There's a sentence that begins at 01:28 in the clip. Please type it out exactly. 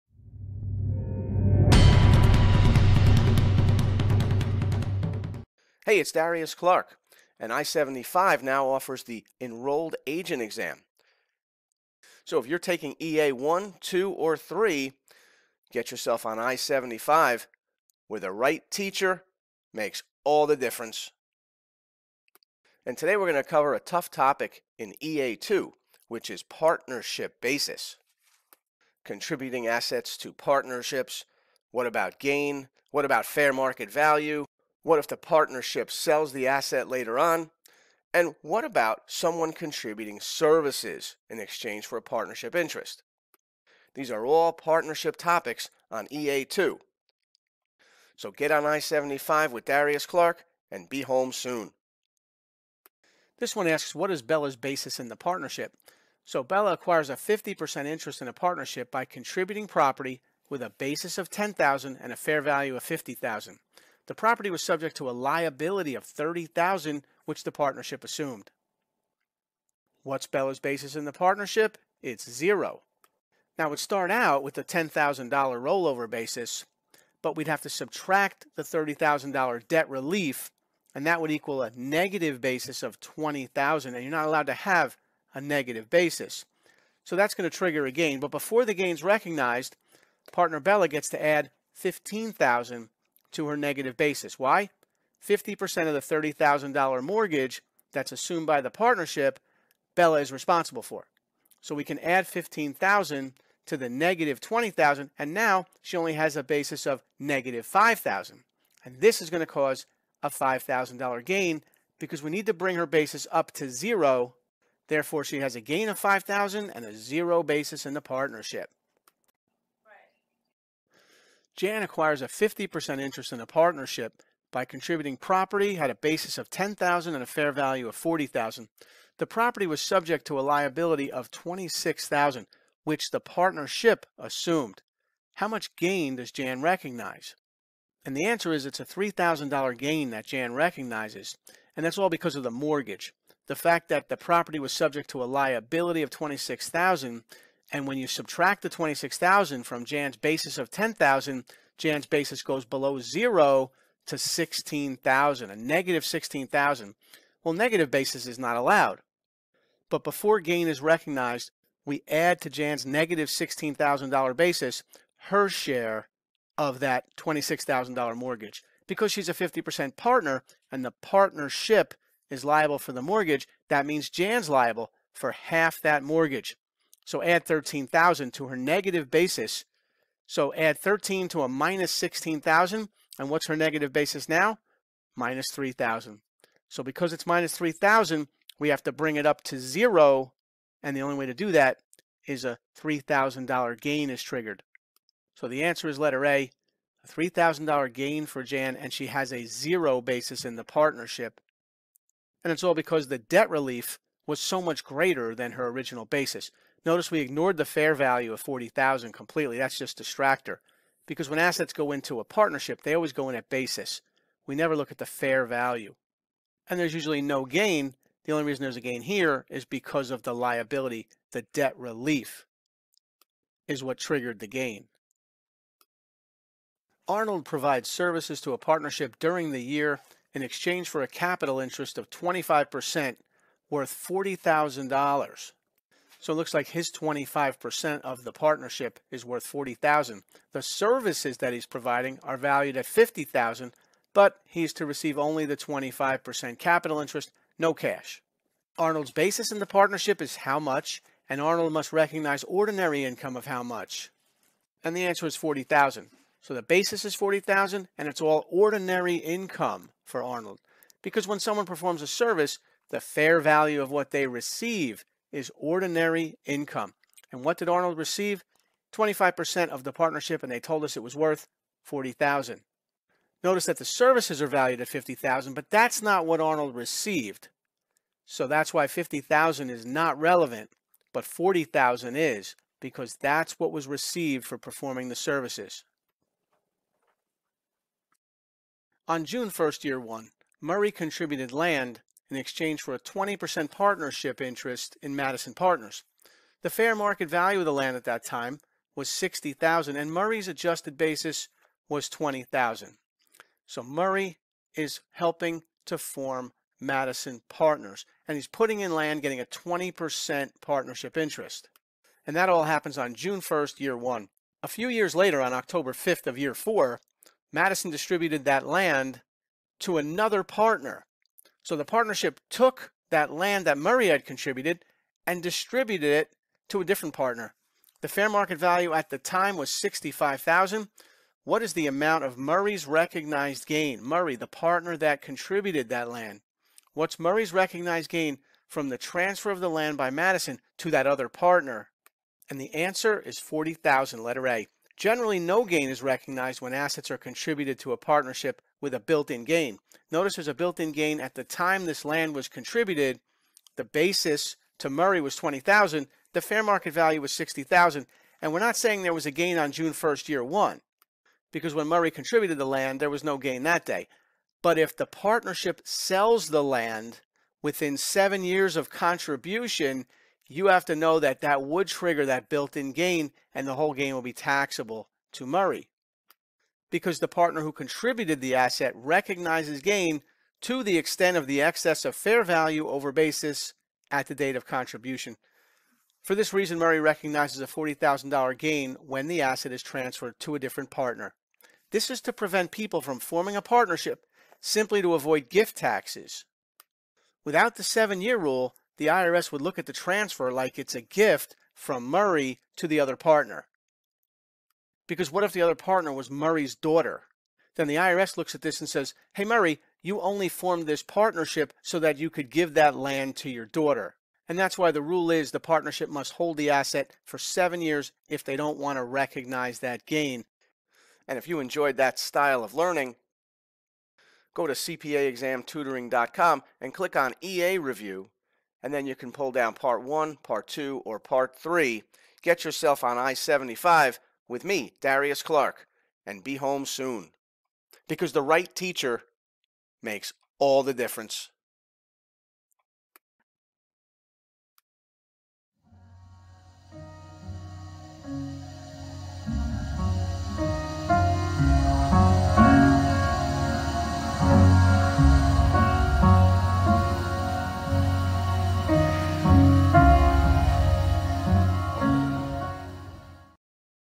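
But before the gain's recognized, partner Bella gets to add 15000 to her negative basis.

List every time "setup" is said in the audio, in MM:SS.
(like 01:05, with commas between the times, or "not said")
not said.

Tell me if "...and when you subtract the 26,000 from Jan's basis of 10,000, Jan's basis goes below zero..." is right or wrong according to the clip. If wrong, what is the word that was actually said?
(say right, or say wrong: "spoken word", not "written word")
right.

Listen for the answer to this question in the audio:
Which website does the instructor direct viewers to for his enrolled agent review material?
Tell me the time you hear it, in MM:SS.
07:04.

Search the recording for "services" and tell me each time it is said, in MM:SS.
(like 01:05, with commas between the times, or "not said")
00:40, 03:47, 04:00, 04:22, 04:33, 04:45.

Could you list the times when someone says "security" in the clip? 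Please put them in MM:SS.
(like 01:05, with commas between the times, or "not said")
not said.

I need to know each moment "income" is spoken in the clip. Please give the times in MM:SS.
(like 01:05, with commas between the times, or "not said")
04:13, 04:19, 04:26.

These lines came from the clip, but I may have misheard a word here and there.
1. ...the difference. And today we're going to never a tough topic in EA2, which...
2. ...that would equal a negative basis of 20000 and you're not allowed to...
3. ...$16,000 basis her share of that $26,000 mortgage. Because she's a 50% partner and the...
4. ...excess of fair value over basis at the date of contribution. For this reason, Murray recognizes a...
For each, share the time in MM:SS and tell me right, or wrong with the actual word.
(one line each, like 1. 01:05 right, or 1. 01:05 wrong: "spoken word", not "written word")
1. 00:20 wrong: "cover", not "never"
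2. 01:21 right
3. 02:43 right
4. 06:21 right.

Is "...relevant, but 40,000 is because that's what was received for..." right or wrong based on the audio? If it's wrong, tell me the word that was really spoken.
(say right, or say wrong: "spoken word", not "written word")
right.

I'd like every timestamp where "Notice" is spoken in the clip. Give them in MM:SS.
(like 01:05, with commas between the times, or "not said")
03:26, 04:33, 05:50.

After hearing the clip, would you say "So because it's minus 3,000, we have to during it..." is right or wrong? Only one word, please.
wrong.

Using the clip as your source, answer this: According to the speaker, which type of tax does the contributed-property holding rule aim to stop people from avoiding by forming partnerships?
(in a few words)
gift taxes.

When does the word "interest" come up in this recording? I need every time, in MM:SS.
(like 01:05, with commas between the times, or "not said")
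00:42, 00:57, 02:02, 03:51, 04:07, 04:54, 05:11.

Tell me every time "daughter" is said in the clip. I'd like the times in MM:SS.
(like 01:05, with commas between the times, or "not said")
06:46, 06:53.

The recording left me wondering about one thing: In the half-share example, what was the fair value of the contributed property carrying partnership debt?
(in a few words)
$50,000.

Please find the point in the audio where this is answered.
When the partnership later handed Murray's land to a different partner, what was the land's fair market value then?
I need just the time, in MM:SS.
05:29.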